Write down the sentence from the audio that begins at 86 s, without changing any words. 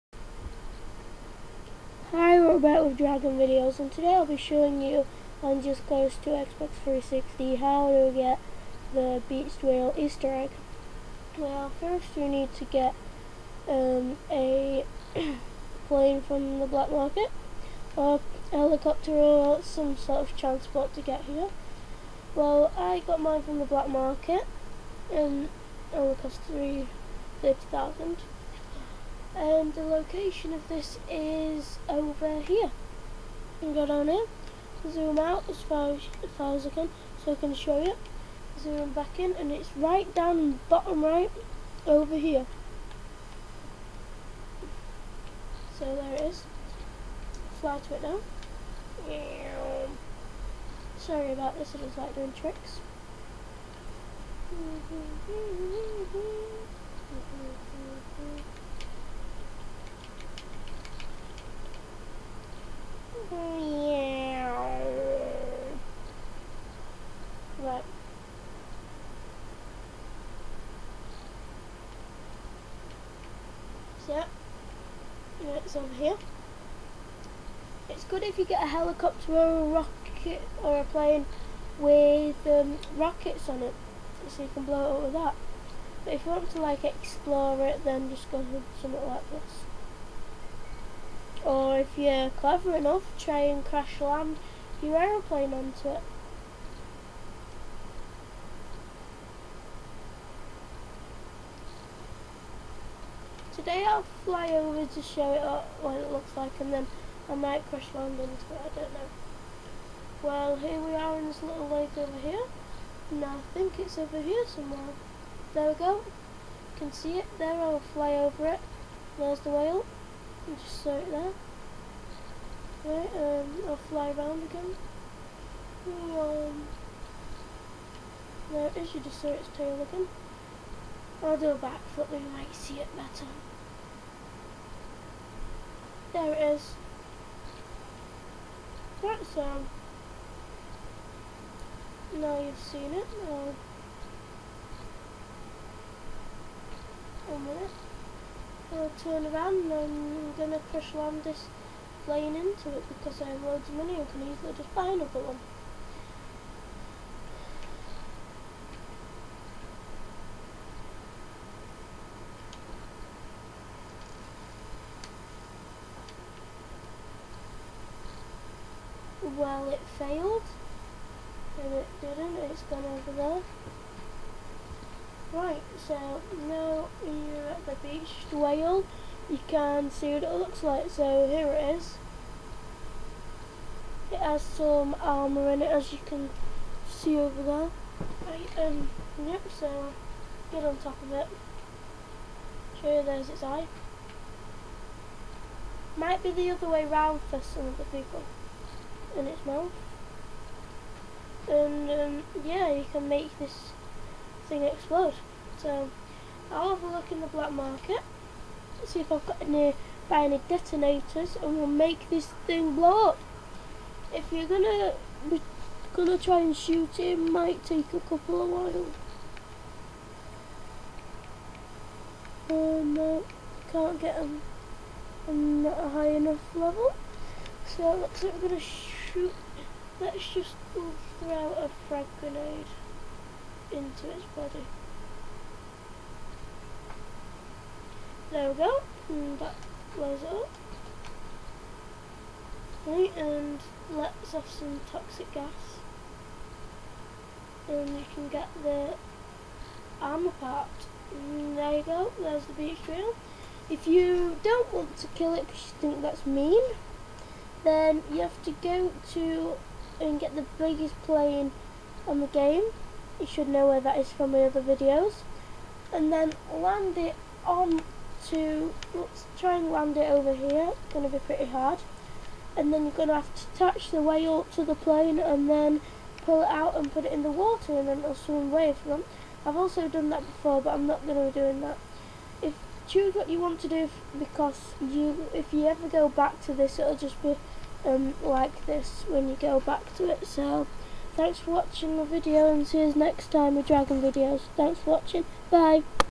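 But if you want to like explore it then just go with something like this.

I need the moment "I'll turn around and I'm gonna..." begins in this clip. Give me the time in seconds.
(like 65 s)
148 s.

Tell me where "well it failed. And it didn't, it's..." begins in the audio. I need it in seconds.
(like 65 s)
169 s.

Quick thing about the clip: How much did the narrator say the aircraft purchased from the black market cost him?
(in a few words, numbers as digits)
350,000.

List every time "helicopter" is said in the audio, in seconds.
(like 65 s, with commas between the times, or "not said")
18 s, 78 s.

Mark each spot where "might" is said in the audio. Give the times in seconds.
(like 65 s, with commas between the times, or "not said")
107 s, 132 s, 195 s, 217 s.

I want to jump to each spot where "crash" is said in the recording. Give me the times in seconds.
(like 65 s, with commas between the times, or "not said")
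93 s, 107 s, 150 s.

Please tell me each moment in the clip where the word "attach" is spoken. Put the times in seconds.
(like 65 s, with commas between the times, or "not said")
273 s.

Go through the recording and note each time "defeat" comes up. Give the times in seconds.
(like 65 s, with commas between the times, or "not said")
not said.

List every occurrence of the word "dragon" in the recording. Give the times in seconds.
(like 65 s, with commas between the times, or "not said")
2 s, 293 s.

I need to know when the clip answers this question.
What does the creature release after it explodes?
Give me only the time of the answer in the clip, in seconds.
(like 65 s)
244 s.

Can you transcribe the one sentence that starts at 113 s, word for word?
And I think it's over here somewhere.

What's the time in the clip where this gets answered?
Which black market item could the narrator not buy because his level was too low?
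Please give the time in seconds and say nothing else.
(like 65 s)
210 s.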